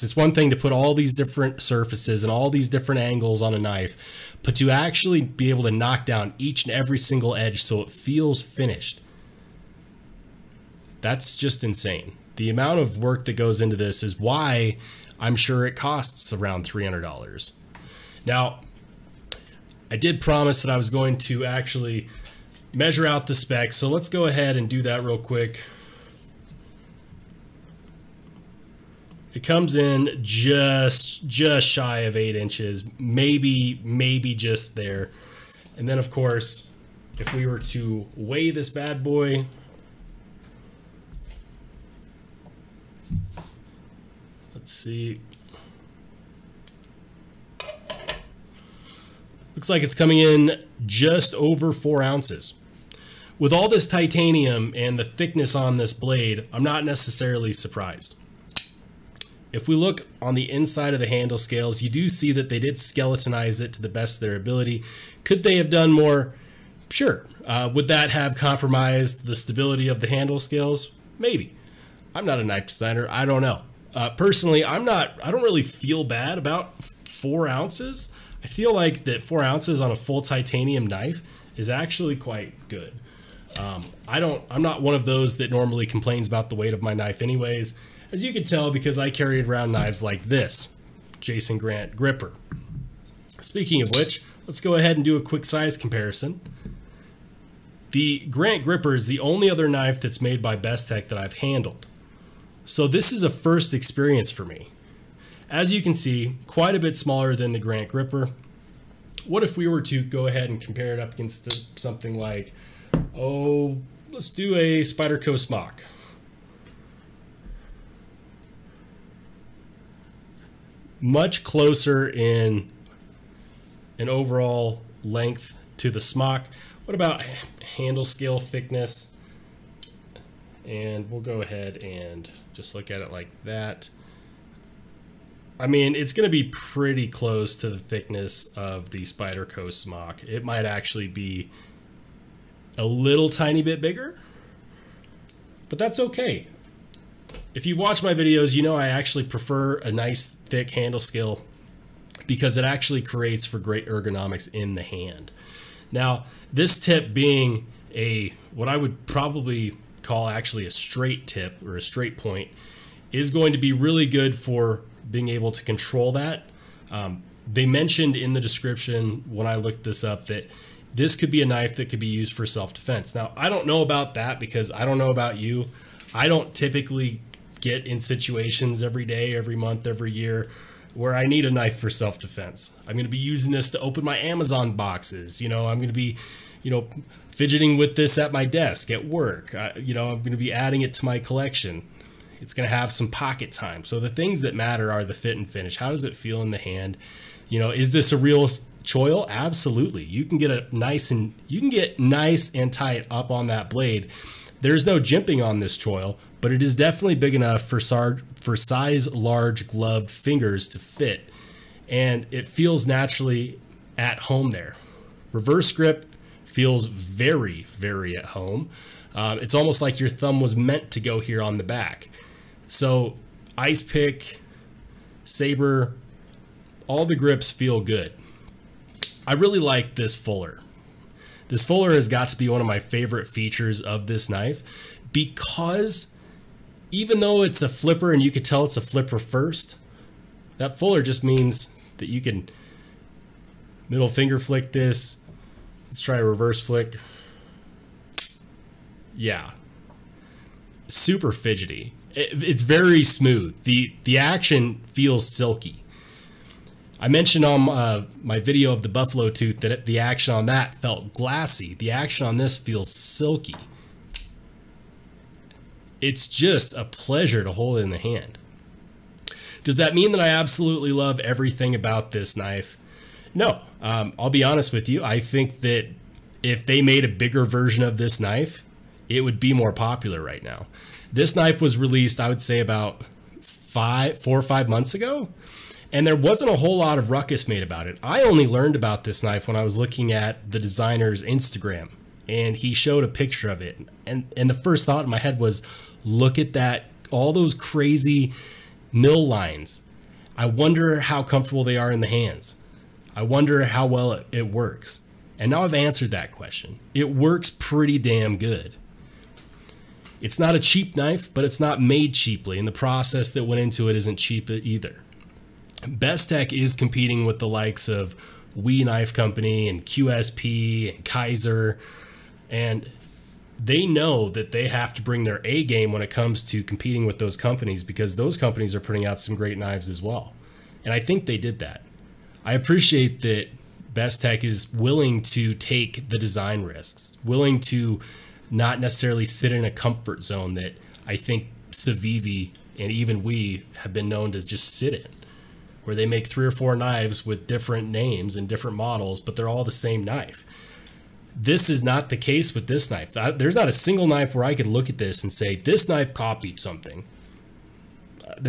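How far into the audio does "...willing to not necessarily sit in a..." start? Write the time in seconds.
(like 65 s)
337 s.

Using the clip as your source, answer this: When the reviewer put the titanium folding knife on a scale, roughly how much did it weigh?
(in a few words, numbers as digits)
just over 4 ounces.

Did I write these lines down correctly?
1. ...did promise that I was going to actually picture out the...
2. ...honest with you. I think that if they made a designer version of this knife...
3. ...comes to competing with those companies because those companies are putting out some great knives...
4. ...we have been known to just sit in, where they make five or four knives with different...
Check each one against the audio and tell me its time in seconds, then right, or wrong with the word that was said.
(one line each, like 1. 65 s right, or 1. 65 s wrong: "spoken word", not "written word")
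1. 19 s wrong: "measure", not "picture"
2. 274 s wrong: "bigger", not "designer"
3. 326 s right
4. 343 s wrong: "three", not "five".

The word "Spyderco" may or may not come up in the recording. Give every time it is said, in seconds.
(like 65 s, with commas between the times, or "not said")
114 s, 139 s.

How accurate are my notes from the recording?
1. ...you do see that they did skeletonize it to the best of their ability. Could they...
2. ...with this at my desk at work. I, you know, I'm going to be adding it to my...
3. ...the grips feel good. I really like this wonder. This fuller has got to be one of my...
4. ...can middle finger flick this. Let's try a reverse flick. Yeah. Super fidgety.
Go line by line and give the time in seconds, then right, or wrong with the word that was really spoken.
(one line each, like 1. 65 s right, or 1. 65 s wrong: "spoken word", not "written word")
1. 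61 s right
2. 187 s right
3. 227 s wrong: "fuller", not "wonder"
4. 242 s right.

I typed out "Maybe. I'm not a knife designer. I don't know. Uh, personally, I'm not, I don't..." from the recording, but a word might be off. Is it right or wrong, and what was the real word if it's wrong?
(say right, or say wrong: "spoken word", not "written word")
right.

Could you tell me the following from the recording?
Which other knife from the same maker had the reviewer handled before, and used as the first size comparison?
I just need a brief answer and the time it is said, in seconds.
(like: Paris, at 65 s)
Jason Grant Gripper, at 91 s.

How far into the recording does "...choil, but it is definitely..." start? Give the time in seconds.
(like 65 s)
205 s.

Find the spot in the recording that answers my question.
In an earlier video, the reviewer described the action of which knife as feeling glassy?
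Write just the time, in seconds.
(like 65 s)
258 s.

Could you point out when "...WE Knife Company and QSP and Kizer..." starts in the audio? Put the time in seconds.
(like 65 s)
318 s.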